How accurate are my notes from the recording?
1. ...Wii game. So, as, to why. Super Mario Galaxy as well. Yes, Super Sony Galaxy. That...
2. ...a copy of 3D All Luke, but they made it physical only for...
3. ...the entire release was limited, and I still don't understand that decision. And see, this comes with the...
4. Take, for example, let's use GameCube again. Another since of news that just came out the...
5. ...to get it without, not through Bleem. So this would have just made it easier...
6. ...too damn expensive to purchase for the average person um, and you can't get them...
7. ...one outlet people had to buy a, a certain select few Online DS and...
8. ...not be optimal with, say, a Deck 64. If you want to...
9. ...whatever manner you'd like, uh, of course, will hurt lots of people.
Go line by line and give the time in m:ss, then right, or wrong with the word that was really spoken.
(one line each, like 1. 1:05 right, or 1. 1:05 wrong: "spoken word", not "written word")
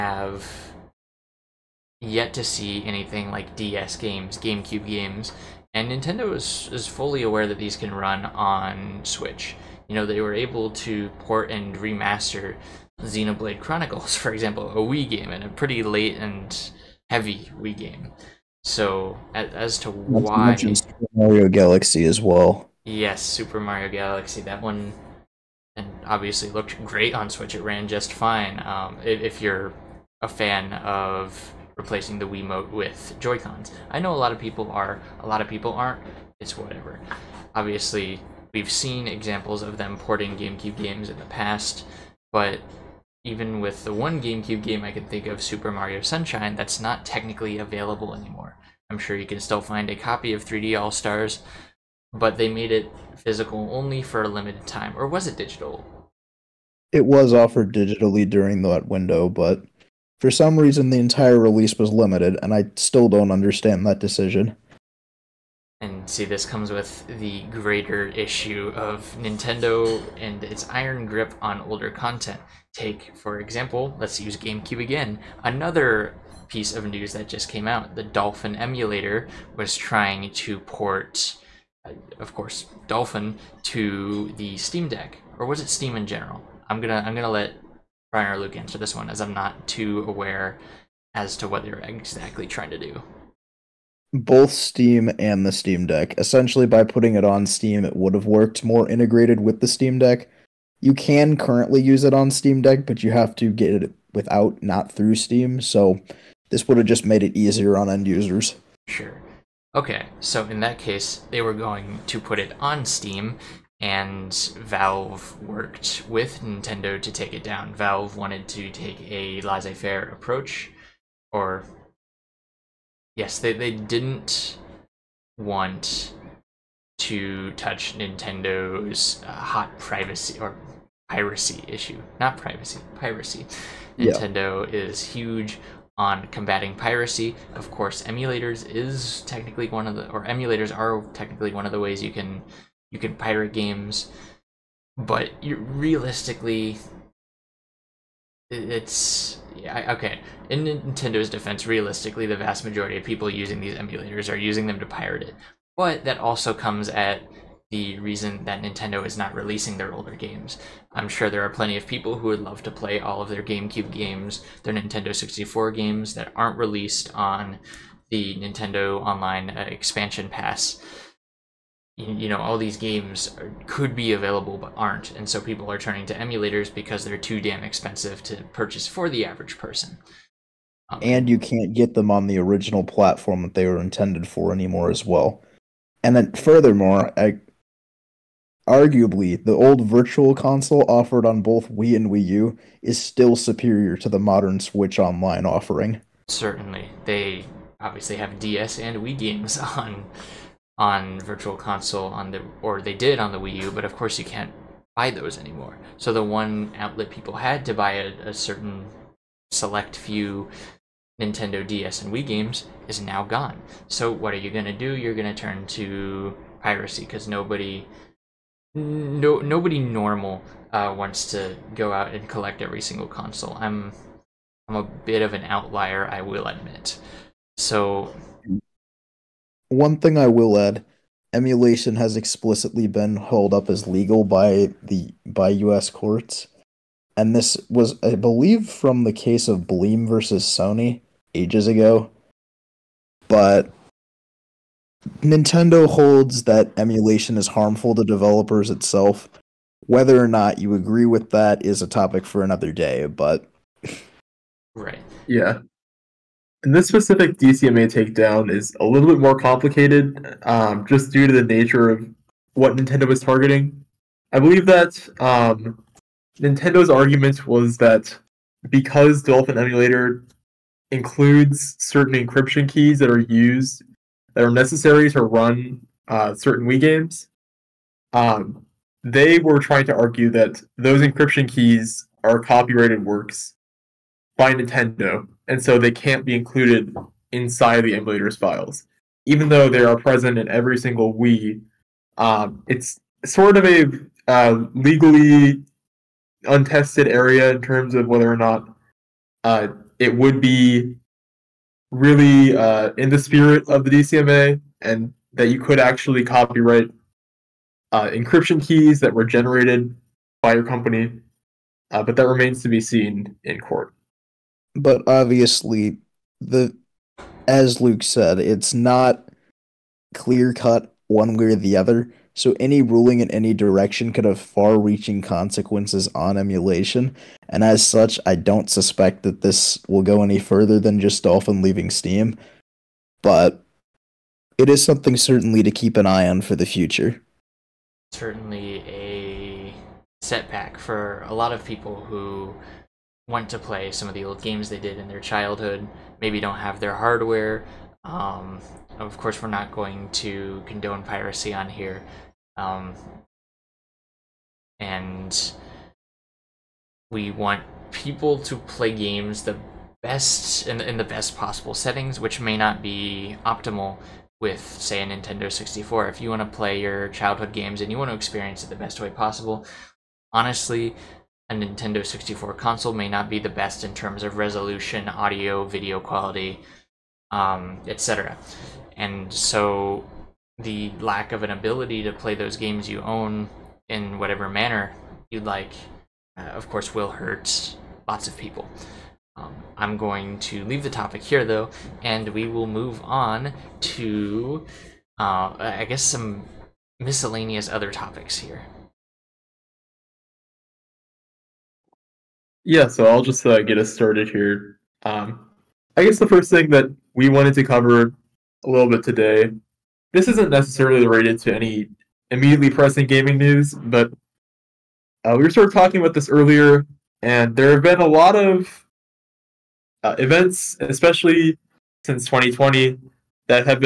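1. 0:17 wrong: "Mario", not "Sony"
2. 0:49 wrong: "Stars", not "Luke"
3. 1:00 right
4. 1:12 wrong: "piece", not "since"
5. 1:43 wrong: "Steam", not "Bleem"
6. 2:57 right
7. 3:26 wrong: "Nintendo", not "Online"
8. 6:02 wrong: "Nintendo", not "Deck"
9. 6:24 right.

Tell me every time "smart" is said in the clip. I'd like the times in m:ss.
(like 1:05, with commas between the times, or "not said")
not said.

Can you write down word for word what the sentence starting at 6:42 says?
Yeah, so I'll just uh, get us started here.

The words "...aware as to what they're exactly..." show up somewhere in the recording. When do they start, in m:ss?
1:30.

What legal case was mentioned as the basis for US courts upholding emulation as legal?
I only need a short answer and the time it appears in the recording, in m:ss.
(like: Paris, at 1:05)
Bleem versus Sony, at 3:59.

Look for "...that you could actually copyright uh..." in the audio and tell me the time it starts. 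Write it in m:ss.
5:05.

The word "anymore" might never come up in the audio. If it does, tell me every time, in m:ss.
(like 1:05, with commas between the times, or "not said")
0:48, 3:04, 3:25.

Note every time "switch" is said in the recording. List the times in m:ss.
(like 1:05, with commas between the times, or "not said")
0:09, 0:27, 3:14.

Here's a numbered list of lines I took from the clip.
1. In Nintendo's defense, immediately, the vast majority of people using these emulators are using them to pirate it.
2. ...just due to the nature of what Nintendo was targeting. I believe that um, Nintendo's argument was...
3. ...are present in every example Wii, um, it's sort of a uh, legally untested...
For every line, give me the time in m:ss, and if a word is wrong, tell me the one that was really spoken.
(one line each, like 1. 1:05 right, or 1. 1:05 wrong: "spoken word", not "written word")
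1. 2:30 wrong: "realistically", not "immediately"
2. 4:20 right
3. 4:49 wrong: "single", not "example".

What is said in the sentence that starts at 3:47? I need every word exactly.
So mm one thing I will add emulation has explicitly been held up as legal by the by US courts.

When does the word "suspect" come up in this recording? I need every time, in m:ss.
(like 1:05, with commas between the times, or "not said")
5:28.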